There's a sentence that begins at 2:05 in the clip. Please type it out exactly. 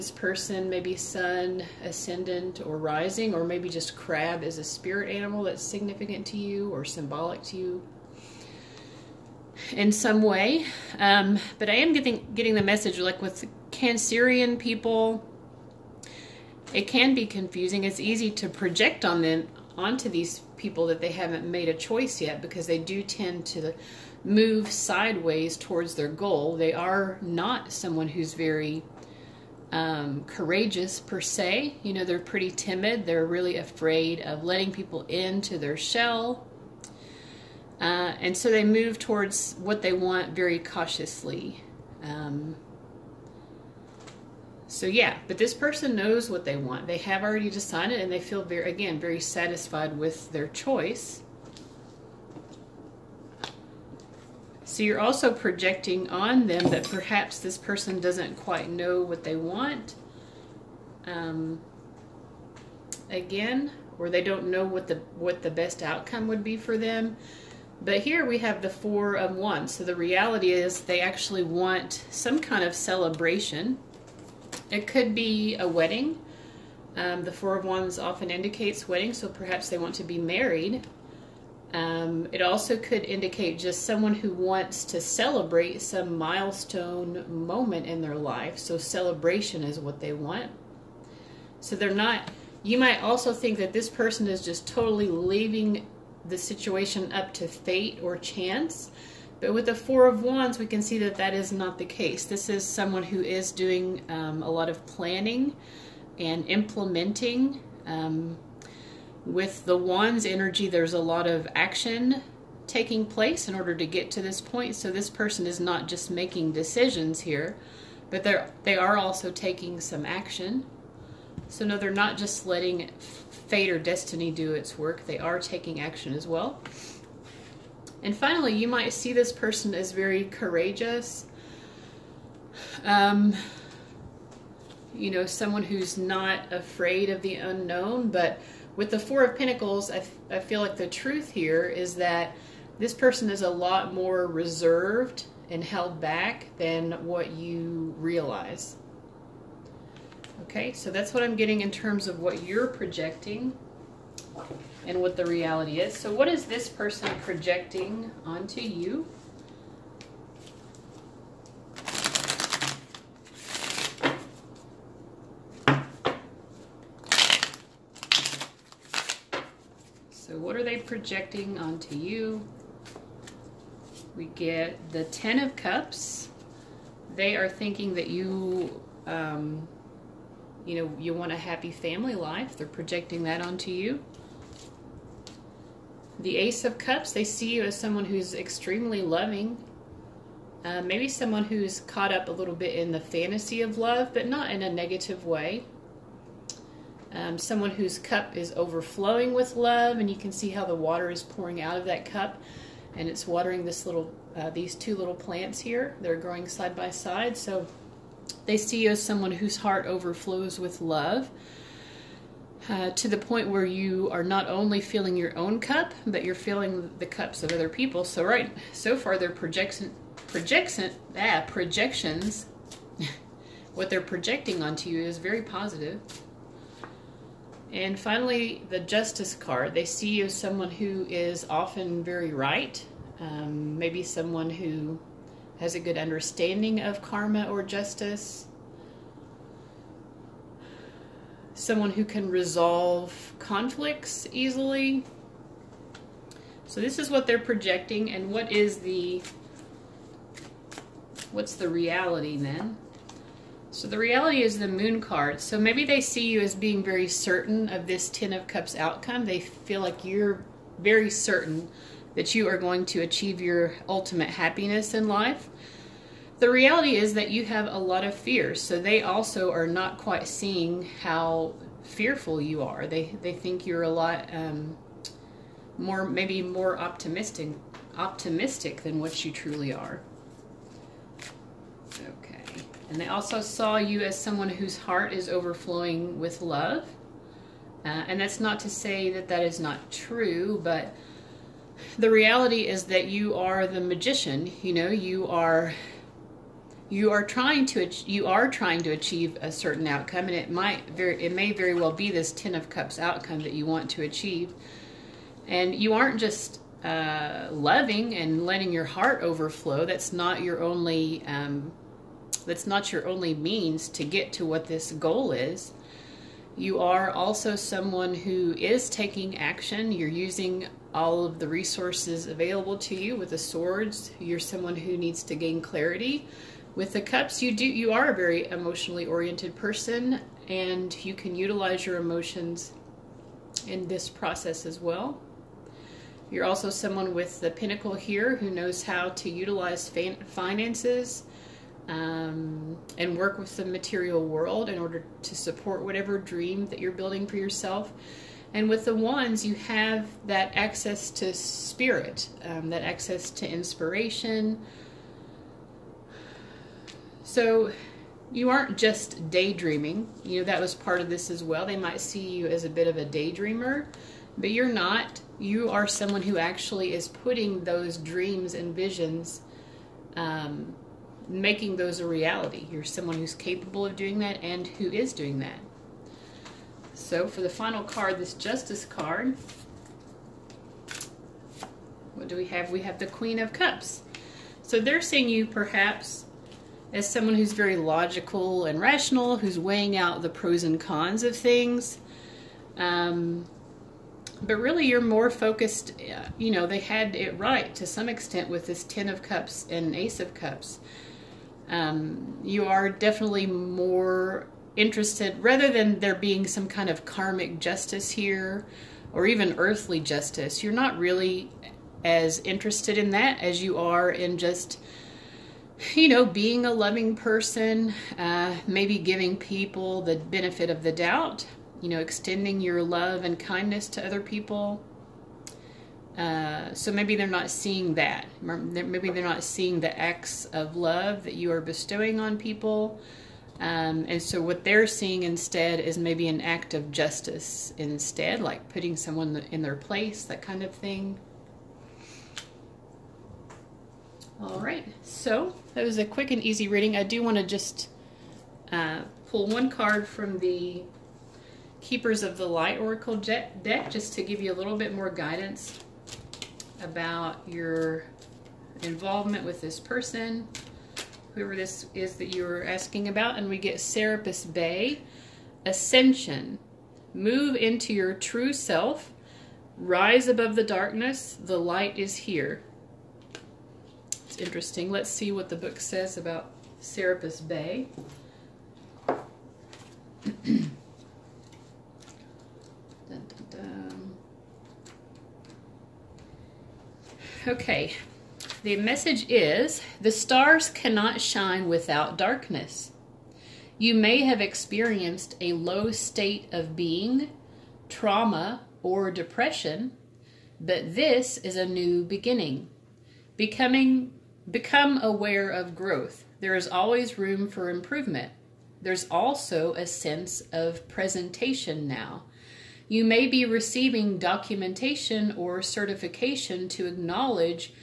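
They are taking action as well.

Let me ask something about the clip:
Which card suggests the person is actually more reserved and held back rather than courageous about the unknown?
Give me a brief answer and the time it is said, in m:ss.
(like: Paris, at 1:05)
Four of Pentacles, at 2:18.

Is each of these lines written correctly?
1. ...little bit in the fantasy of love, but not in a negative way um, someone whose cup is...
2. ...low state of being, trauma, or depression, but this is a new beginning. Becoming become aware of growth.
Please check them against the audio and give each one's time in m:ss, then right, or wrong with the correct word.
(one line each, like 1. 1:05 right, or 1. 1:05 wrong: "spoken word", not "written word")
1. 3:12 right
2. 8:15 right.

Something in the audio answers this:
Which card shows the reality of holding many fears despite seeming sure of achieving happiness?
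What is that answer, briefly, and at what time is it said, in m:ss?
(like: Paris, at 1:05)
The Moon, at 4:14.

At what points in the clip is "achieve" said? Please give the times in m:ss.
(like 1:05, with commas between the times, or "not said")
4:23, 4:58, 5:04.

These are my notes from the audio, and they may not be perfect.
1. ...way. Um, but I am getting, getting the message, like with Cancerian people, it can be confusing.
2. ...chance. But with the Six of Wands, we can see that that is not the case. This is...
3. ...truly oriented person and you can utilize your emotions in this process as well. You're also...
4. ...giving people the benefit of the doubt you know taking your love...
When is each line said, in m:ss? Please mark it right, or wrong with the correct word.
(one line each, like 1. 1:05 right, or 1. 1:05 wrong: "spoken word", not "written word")
1. 0:10 right
2. 1:38 wrong: "Four", not "Six"
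3. 5:28 wrong: "emotionally", not "truly"
4. 6:58 wrong: "extending", not "taking".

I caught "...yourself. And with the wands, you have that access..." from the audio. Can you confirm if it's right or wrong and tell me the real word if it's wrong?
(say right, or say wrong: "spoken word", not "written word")
right.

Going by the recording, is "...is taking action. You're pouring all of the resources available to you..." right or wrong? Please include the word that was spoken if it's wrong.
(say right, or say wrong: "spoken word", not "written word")
wrong: "using", not "pouring".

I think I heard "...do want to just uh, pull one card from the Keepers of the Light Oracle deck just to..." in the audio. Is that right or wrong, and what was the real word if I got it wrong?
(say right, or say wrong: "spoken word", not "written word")
right.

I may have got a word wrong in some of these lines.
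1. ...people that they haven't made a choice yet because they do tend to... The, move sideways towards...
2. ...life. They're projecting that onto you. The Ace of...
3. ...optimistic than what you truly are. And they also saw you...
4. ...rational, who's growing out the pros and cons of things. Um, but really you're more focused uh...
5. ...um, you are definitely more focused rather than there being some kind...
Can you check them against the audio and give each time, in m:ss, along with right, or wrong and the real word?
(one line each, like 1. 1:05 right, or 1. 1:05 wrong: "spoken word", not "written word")
1. 0:20 right
2. 3:02 right
3. 4:37 right
4. 6:28 wrong: "weighing", not "growing"
5. 6:41 wrong: "interested", not "focused".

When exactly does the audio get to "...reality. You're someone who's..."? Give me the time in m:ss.
6:12.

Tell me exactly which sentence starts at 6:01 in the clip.
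They might see you as a bit of a daydreamer, but you're not.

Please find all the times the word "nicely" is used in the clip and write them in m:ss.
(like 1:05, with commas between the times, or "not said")
not said.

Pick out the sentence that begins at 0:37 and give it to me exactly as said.
Uh, and so they move towards what they want very cautiously.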